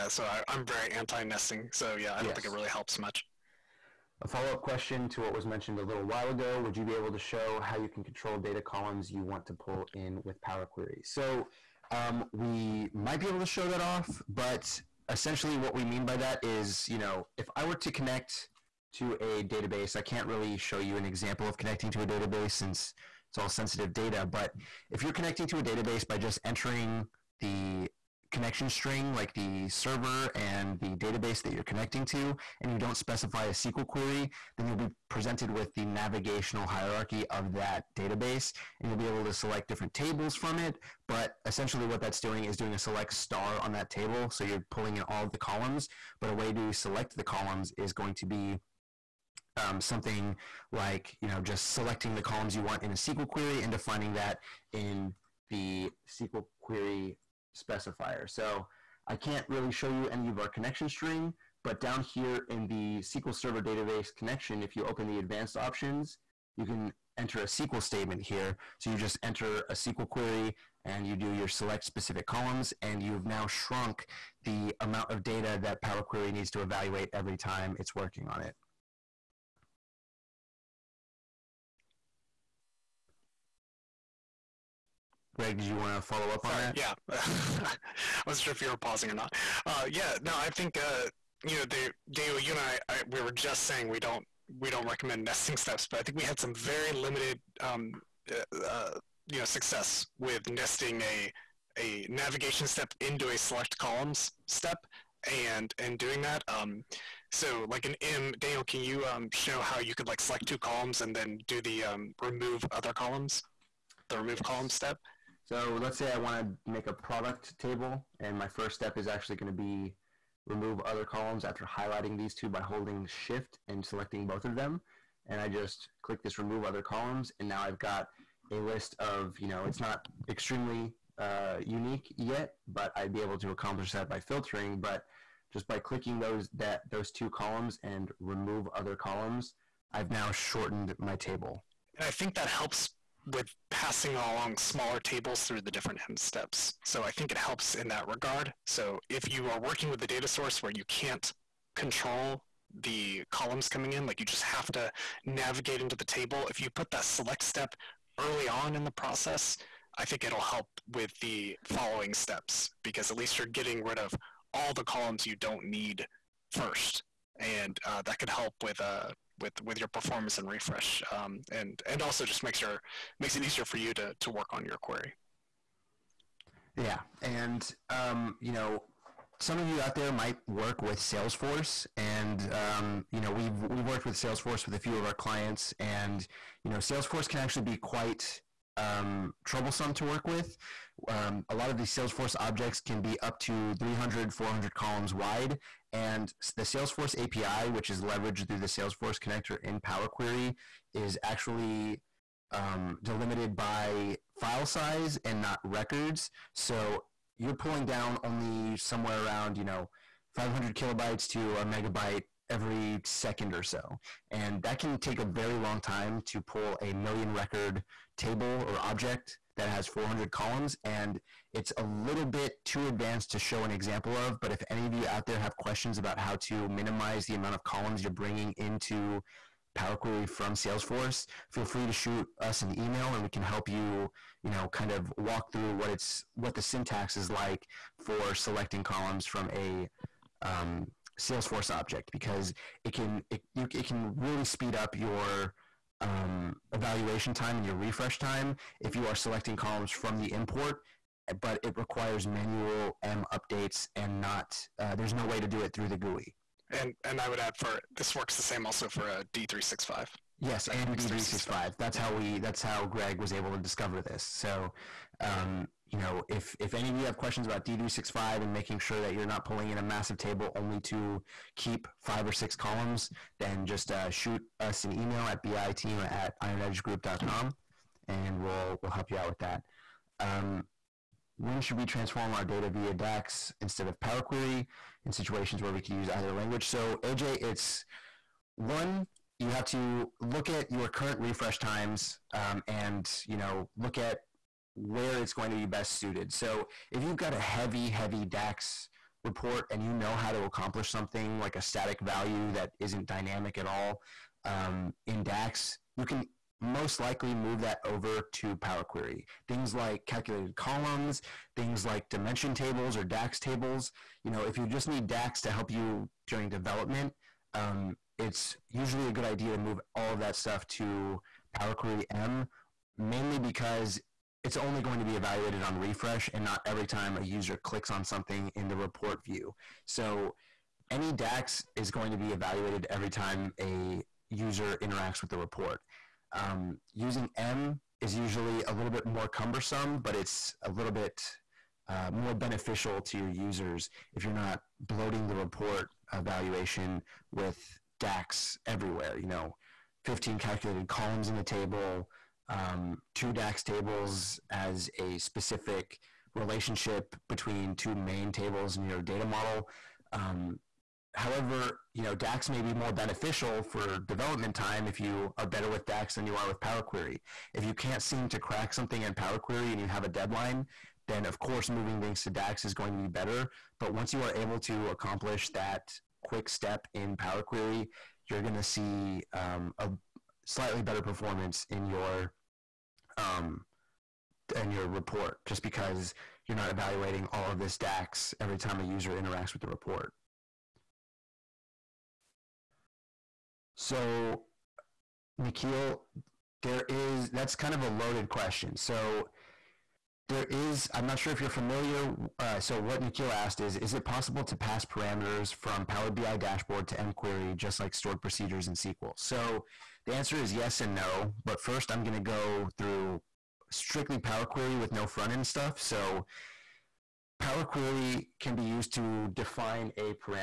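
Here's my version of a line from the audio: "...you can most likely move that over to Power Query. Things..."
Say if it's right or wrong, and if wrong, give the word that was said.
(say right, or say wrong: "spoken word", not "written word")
right.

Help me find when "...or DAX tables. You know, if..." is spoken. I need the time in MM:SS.
05:12.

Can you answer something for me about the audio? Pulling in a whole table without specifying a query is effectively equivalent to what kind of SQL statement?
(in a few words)
select star.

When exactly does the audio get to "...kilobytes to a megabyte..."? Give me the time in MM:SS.
03:30.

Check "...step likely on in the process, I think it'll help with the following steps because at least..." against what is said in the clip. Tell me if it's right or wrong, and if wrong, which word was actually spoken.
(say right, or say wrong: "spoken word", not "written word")
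wrong: "early", not "likely".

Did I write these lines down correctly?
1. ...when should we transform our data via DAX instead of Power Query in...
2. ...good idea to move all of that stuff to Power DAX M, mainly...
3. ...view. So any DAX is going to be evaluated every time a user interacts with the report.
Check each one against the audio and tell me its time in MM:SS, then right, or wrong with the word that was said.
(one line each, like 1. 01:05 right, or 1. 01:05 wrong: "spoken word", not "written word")
1. 04:41 right
2. 05:19 wrong: "Query", not "DAX"
3. 05:29 right.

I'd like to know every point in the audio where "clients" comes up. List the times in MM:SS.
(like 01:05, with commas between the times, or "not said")
03:05.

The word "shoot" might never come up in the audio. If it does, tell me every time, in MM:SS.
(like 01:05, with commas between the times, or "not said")
03:51, 04:34.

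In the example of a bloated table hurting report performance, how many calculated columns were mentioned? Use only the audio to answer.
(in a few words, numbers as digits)
15.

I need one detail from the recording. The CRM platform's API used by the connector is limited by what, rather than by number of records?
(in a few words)
file size.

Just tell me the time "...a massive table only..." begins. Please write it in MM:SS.
04:29.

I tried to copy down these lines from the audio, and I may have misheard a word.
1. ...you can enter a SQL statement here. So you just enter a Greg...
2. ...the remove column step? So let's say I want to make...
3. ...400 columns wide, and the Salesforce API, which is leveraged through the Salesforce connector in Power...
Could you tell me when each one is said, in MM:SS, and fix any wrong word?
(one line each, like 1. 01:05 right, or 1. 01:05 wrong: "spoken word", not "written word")
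1. 01:06 wrong: "SQL", not "Greg"
2. 01:54 right
3. 03:14 right.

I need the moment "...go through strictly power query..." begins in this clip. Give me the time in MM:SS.
06:52.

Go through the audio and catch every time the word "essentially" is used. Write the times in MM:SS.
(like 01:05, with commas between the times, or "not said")
00:15, 00:41.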